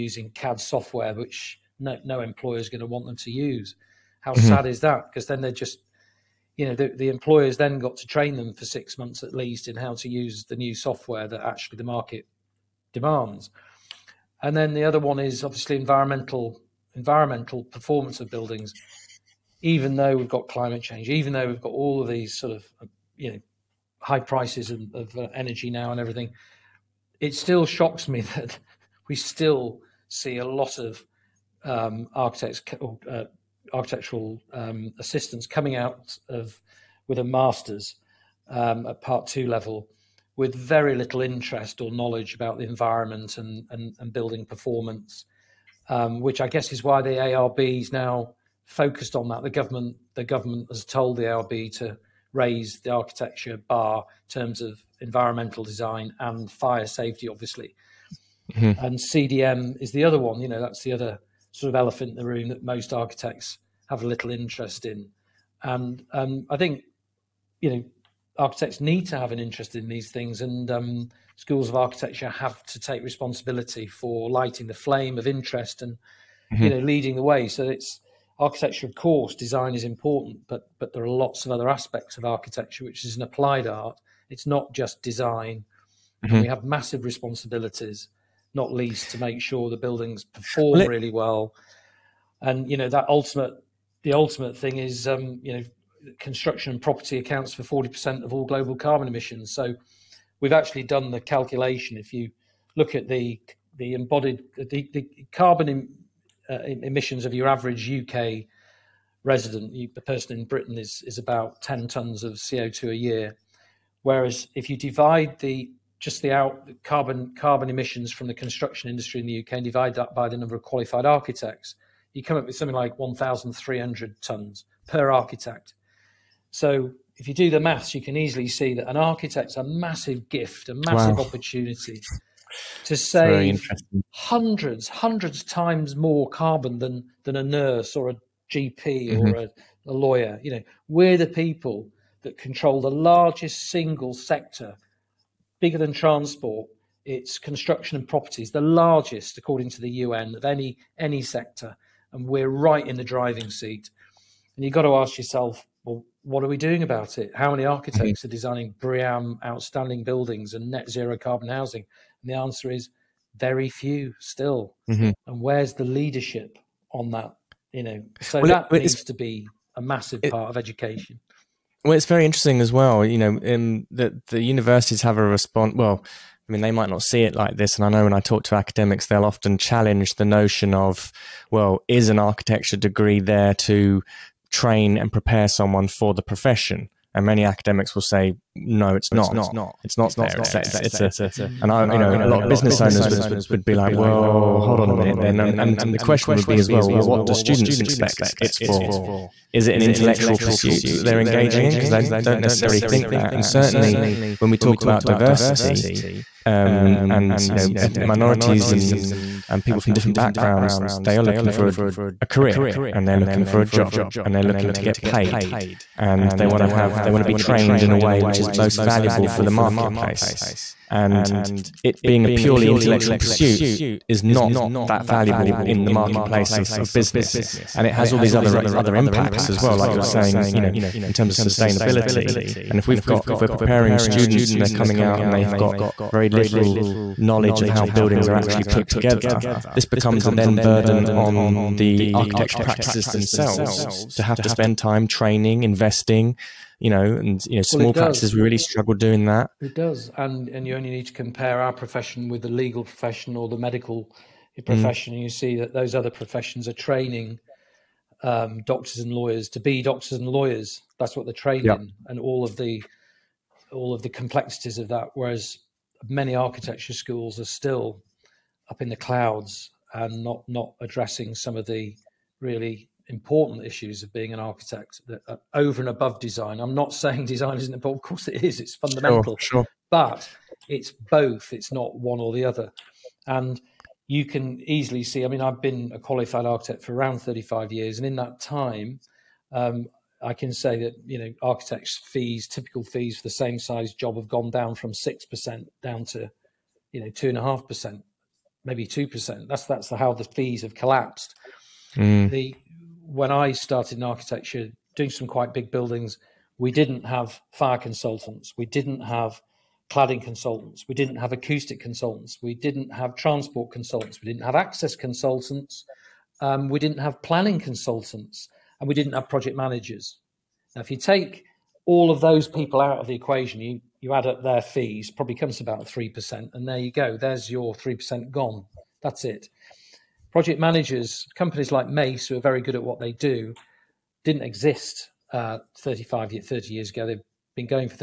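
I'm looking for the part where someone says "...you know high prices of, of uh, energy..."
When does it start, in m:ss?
0:23.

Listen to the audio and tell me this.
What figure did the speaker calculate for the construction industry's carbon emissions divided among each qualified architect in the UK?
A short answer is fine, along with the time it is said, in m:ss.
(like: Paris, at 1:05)
1,300 tons, at 2:02.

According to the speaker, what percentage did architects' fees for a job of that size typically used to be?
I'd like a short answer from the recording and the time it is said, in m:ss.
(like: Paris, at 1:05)
6%, at 4:54.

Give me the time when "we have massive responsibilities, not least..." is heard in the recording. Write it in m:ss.
1:26.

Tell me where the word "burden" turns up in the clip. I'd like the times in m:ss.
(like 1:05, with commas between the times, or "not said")
4:00.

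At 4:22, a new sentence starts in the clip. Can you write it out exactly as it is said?
and all of the all of the complexities of that.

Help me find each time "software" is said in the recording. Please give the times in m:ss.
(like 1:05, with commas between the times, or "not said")
0:00, 0:10.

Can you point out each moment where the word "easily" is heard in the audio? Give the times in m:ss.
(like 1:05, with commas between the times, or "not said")
2:08, 4:44.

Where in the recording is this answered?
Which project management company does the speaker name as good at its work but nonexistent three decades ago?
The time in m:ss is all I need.
5:31.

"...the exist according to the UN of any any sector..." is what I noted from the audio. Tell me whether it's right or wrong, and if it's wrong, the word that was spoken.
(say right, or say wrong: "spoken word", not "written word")
wrong: "largest", not "exist".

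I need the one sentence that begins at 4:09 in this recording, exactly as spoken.
It does, and and you only need to compare our profession with the legal profession or the medical mm.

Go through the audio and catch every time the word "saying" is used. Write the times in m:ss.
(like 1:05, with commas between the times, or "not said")
3:50, 4:36.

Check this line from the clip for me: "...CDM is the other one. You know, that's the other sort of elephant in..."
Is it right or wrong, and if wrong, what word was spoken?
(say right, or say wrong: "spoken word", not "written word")
right.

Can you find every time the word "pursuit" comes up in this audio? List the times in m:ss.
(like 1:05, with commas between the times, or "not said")
3:20, 3:43.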